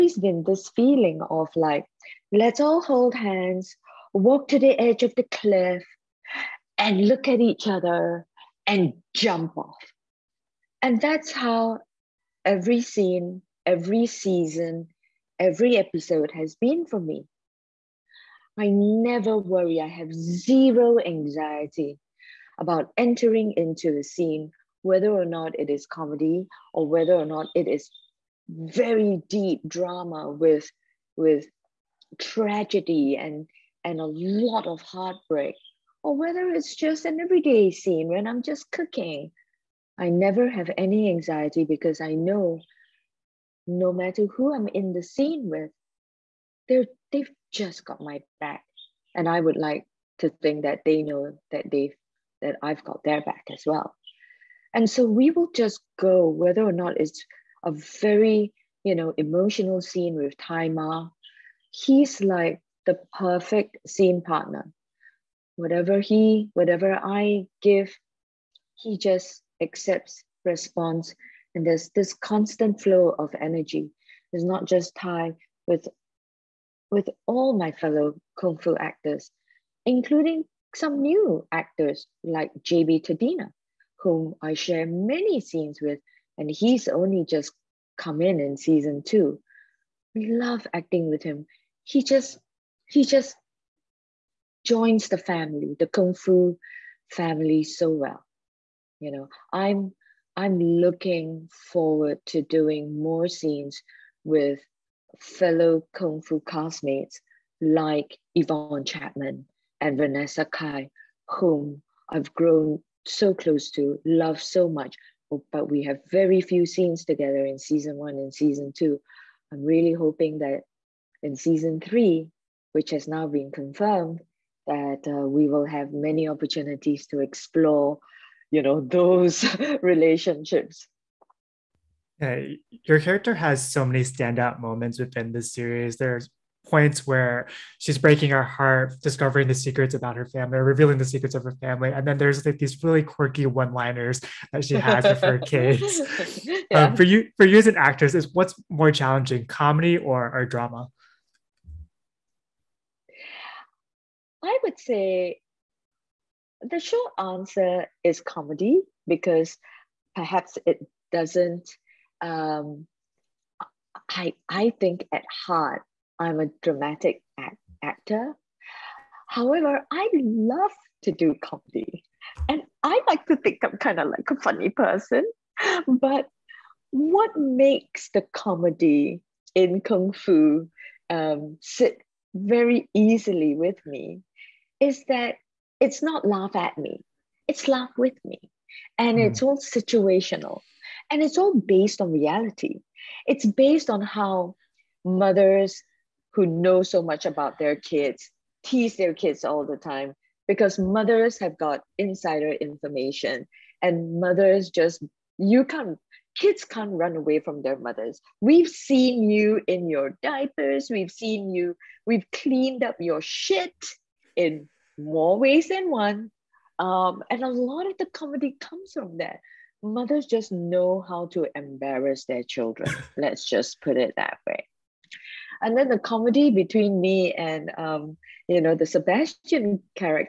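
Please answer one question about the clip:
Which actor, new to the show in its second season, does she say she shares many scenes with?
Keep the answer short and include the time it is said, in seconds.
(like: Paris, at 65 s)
JB Tadena, at 82 s.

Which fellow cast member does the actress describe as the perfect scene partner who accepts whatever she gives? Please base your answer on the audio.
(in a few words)
Tzi Ma.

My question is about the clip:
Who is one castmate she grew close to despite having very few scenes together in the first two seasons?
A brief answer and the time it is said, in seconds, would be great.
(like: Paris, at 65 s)
Yvonne Chapman, at 108 s.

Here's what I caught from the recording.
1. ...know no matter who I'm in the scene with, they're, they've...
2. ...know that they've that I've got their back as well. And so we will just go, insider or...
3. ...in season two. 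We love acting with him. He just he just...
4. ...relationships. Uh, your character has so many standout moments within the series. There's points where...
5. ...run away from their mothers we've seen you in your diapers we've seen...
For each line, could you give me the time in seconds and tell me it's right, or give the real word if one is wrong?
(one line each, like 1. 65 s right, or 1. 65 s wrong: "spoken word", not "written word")
1. 42 s right
2. 51 s wrong: "whether", not "insider"
3. 88 s right
4. 129 s right
5. 206 s right.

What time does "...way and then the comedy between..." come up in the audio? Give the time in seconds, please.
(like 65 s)
224 s.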